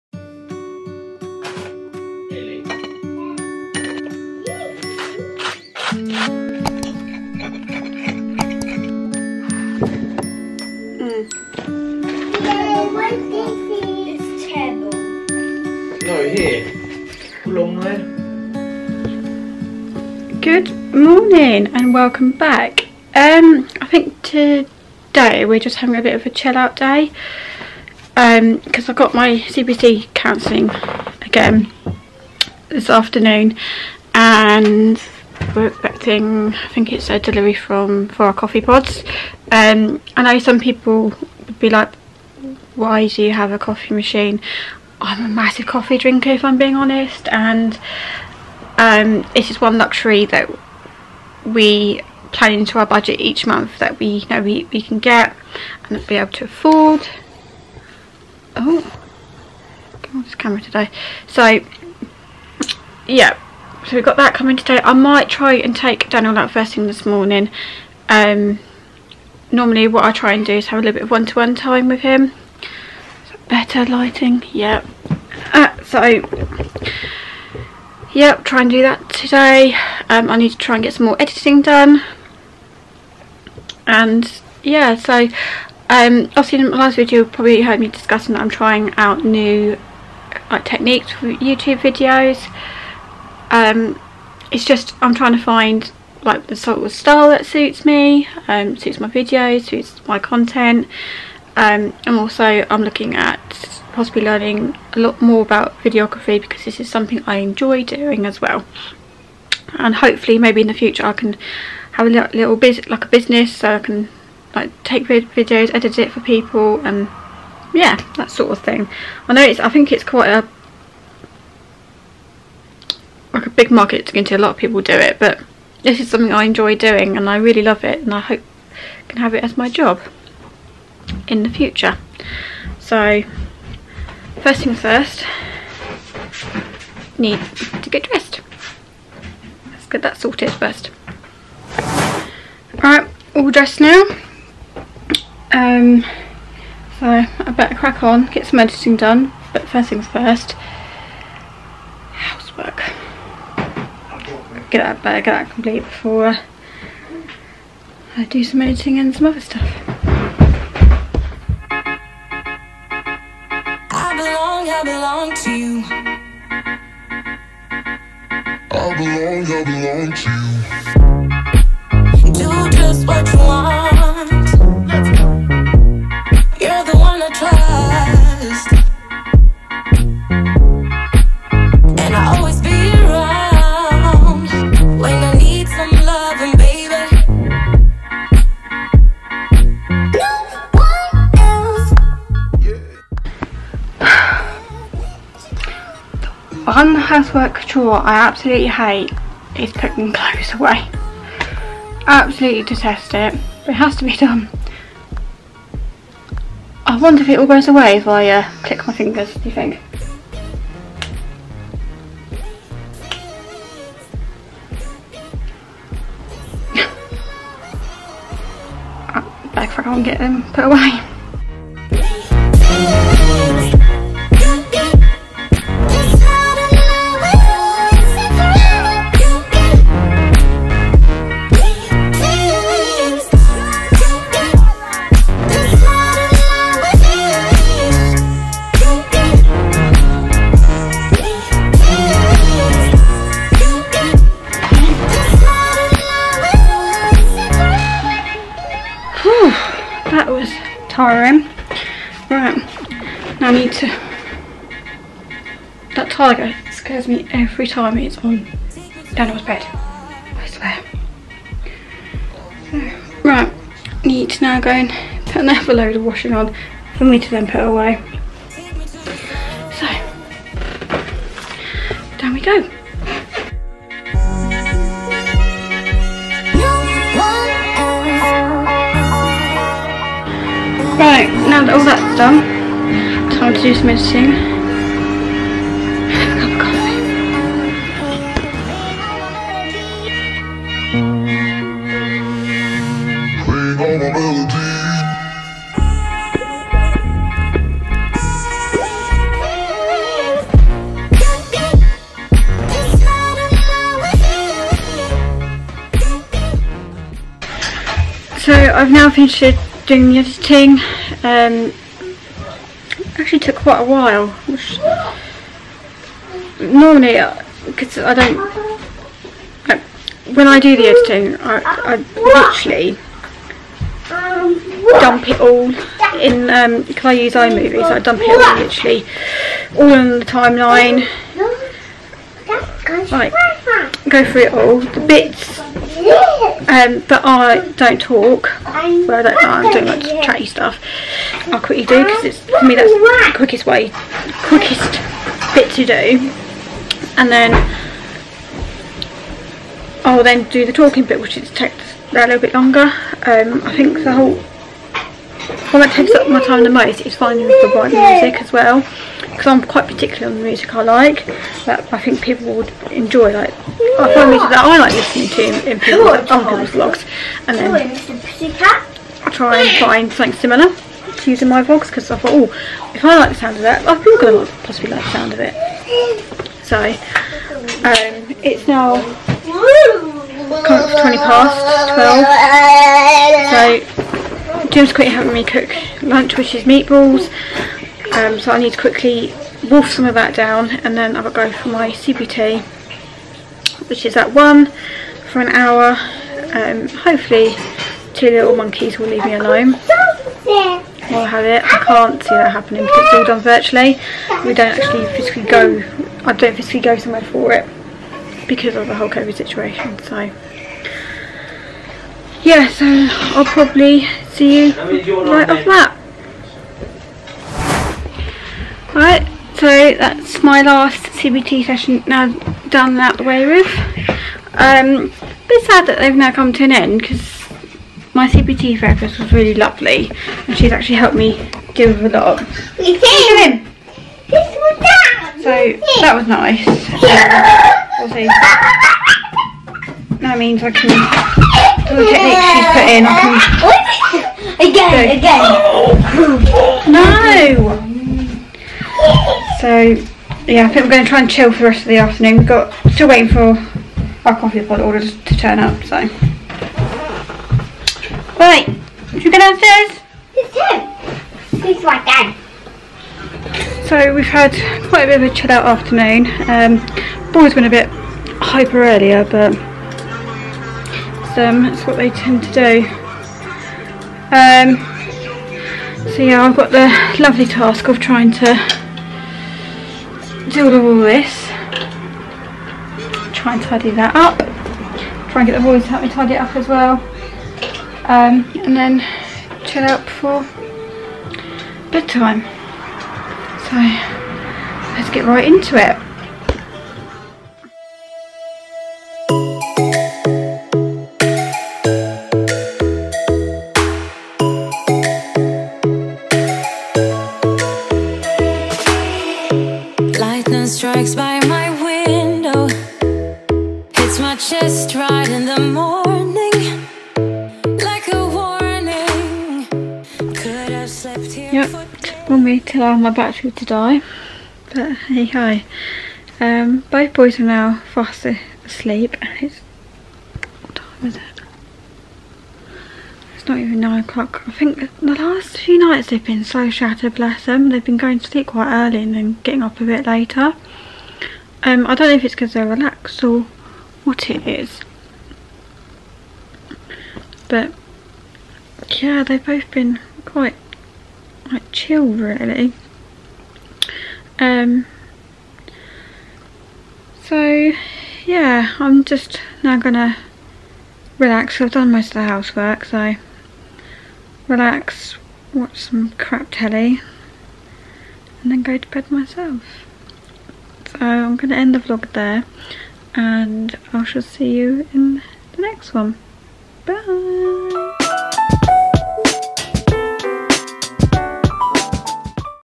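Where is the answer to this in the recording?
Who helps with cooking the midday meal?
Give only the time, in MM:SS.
06:24.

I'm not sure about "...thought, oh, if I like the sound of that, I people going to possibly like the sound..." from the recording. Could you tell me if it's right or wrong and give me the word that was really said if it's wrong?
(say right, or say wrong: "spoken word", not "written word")
right.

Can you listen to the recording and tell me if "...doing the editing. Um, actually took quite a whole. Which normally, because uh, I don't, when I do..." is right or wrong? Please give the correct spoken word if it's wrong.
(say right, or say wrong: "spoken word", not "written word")
wrong: "while", not "whole".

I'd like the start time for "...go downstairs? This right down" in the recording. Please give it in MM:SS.
07:39.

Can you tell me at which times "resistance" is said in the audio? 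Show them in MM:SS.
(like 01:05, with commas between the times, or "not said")
not said.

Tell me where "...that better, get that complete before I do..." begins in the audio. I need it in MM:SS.
02:34.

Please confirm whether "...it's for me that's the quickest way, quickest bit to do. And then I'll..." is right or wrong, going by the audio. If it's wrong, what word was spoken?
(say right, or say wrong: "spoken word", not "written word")
right.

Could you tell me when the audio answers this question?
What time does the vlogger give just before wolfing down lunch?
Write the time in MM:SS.
06:19.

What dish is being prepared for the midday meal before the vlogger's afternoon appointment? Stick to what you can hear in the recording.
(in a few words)
Meatballs.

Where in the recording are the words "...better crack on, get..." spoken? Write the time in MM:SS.
02:27.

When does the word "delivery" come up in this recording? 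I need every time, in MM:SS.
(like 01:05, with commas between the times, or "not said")
00:37.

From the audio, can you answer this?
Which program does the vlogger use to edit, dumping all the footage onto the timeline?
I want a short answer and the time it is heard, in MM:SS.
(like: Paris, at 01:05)
iMovie, at 05:27.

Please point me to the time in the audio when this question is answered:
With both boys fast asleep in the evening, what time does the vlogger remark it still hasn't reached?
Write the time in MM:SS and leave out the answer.
08:53.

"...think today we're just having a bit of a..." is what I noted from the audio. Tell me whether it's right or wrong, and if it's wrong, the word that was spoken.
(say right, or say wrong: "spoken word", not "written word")
right.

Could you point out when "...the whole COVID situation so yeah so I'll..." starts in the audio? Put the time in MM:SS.
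06:48.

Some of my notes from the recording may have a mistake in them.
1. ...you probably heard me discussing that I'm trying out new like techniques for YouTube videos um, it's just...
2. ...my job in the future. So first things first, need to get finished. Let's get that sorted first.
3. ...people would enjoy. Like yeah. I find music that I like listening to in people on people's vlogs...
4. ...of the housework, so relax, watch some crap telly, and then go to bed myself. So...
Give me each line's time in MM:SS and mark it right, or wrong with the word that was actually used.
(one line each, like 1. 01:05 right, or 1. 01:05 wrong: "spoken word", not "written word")
1. 01:27 right
2. 02:09 wrong: "dressed", not "finished"
3. 06:02 right
4. 09:22 right.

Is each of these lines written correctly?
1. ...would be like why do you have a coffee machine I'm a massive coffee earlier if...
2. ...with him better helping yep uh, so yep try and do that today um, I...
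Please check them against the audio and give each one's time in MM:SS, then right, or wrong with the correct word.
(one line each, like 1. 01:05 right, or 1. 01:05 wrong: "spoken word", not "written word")
1. 00:41 wrong: "drinker", not "earlier"
2. 01:11 wrong: "lighting", not "helping".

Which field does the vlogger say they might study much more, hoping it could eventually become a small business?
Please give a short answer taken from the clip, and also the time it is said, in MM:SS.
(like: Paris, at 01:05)
Videography, at 01:45.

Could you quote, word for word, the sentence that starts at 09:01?
Um, I don't know if it's because they're relaxed or what it is.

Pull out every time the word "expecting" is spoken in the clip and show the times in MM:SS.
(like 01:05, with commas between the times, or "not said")
00:35.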